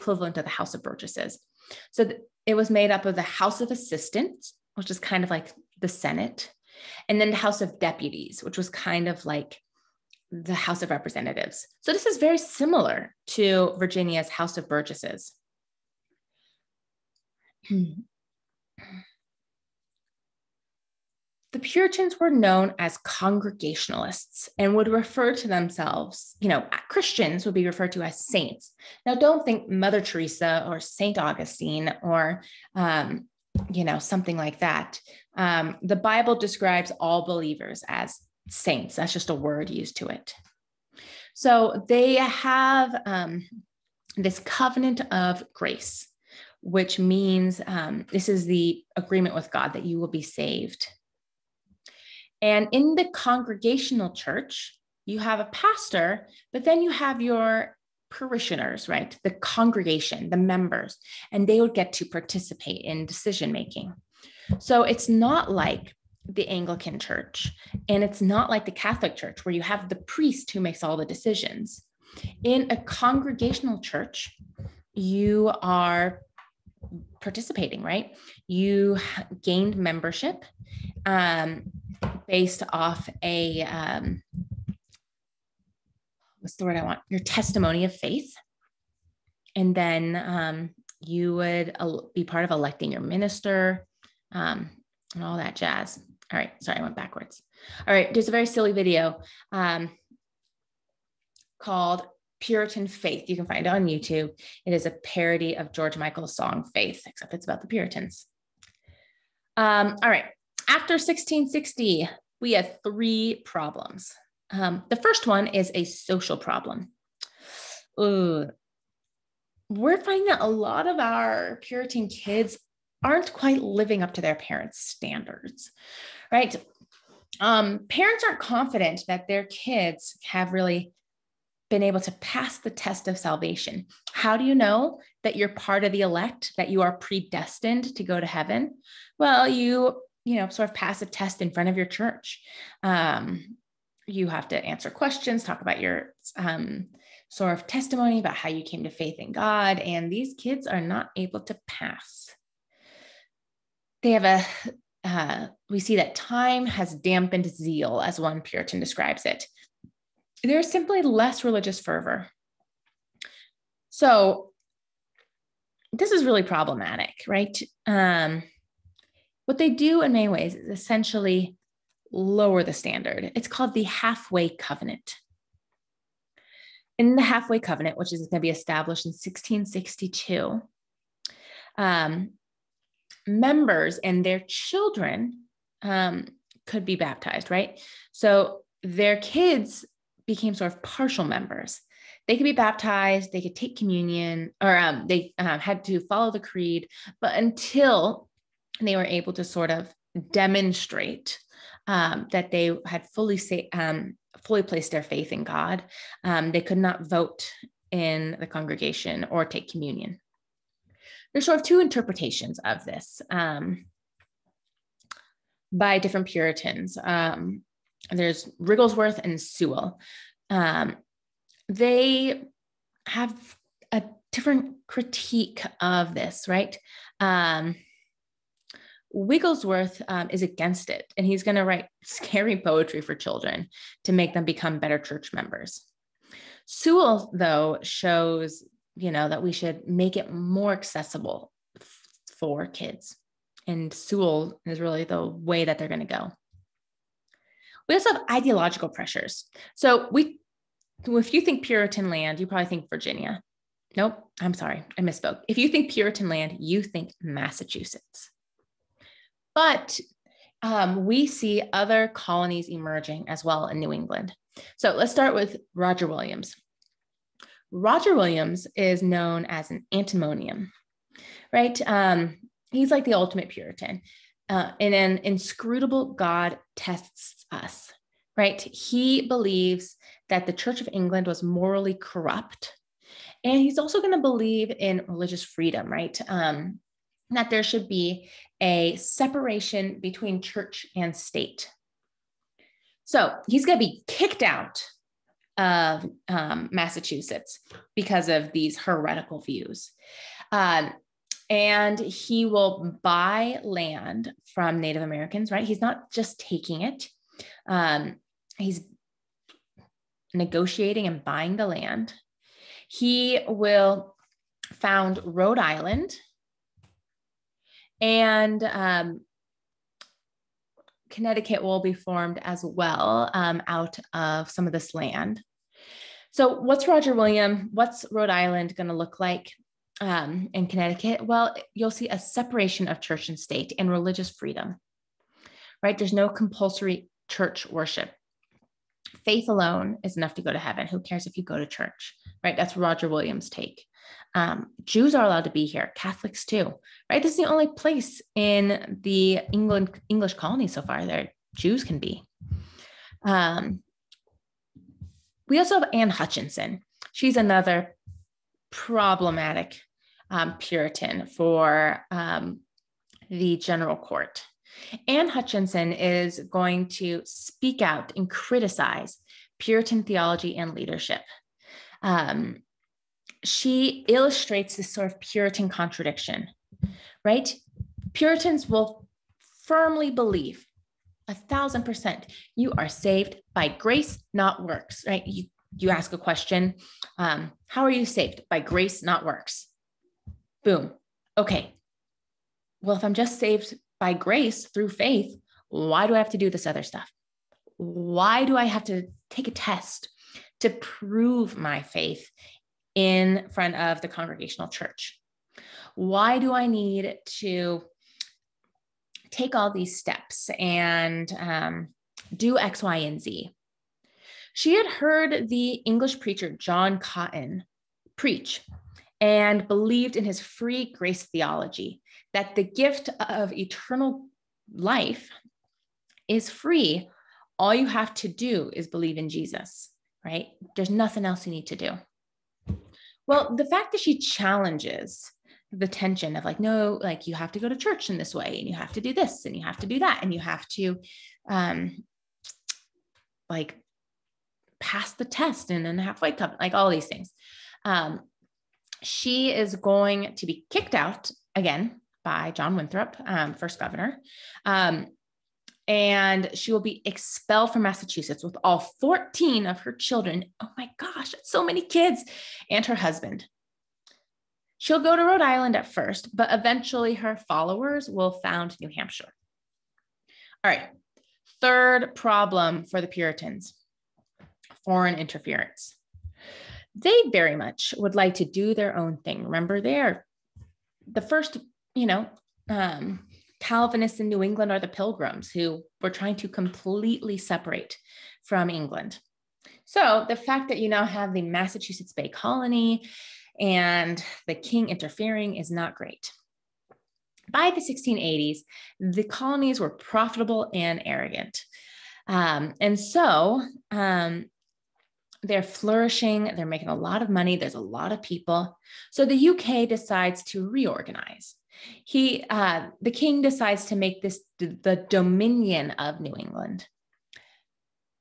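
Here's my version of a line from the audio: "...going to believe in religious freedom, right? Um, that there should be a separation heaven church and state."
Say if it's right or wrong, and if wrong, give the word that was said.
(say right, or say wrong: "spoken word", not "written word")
wrong: "between", not "heaven".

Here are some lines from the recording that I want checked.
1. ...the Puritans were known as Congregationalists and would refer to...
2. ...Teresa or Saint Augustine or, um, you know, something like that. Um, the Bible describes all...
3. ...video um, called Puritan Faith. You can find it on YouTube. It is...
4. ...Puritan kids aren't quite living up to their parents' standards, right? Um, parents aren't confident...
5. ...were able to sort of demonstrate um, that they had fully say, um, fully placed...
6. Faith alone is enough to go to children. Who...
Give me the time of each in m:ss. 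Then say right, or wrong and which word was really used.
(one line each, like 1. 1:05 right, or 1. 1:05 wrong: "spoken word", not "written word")
1. 0:17 right
2. 0:30 right
3. 1:38 right
4. 2:01 right
5. 3:18 right
6. 5:39 wrong: "heaven", not "children".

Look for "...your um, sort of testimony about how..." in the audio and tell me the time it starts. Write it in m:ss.
2:25.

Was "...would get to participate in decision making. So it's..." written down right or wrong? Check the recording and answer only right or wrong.
right.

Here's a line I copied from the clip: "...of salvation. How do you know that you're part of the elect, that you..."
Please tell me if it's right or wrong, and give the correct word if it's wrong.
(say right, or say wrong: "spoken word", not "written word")
right.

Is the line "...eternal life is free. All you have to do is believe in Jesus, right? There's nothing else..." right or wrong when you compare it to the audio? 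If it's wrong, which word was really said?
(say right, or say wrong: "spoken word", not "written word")
right.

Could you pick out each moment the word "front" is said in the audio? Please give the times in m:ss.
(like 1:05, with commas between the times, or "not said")
2:21, 6:43.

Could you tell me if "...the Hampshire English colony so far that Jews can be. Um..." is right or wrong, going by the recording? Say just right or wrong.
wrong.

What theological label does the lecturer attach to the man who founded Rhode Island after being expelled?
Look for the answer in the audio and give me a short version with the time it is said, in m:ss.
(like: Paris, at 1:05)
antinomian, at 4:29.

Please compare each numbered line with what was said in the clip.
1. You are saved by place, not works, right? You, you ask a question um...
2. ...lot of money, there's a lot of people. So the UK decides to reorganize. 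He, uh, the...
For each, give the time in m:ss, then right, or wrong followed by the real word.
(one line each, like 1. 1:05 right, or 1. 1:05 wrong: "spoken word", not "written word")
1. 6:22 wrong: "grace", not "place"
2. 8:26 right.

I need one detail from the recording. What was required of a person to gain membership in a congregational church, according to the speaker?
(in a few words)
testimony of faith.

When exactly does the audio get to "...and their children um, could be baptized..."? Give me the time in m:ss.
3:03.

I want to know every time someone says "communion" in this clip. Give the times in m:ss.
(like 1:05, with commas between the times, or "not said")
3:13, 3:29.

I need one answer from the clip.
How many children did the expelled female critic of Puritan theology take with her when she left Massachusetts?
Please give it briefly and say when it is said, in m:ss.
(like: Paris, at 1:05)
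14, at 7:38.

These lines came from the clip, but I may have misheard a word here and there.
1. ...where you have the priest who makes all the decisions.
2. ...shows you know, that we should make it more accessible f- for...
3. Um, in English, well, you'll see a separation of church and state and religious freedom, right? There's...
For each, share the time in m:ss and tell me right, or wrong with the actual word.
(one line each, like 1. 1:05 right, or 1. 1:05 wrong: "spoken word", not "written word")
1. 1:09 right
2. 3:57 right
3. 5:29 wrong: "Connecticut", not "English".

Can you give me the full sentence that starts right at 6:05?
Anne Hutchinson is going to speak out and criticize Puritan theology and leadership.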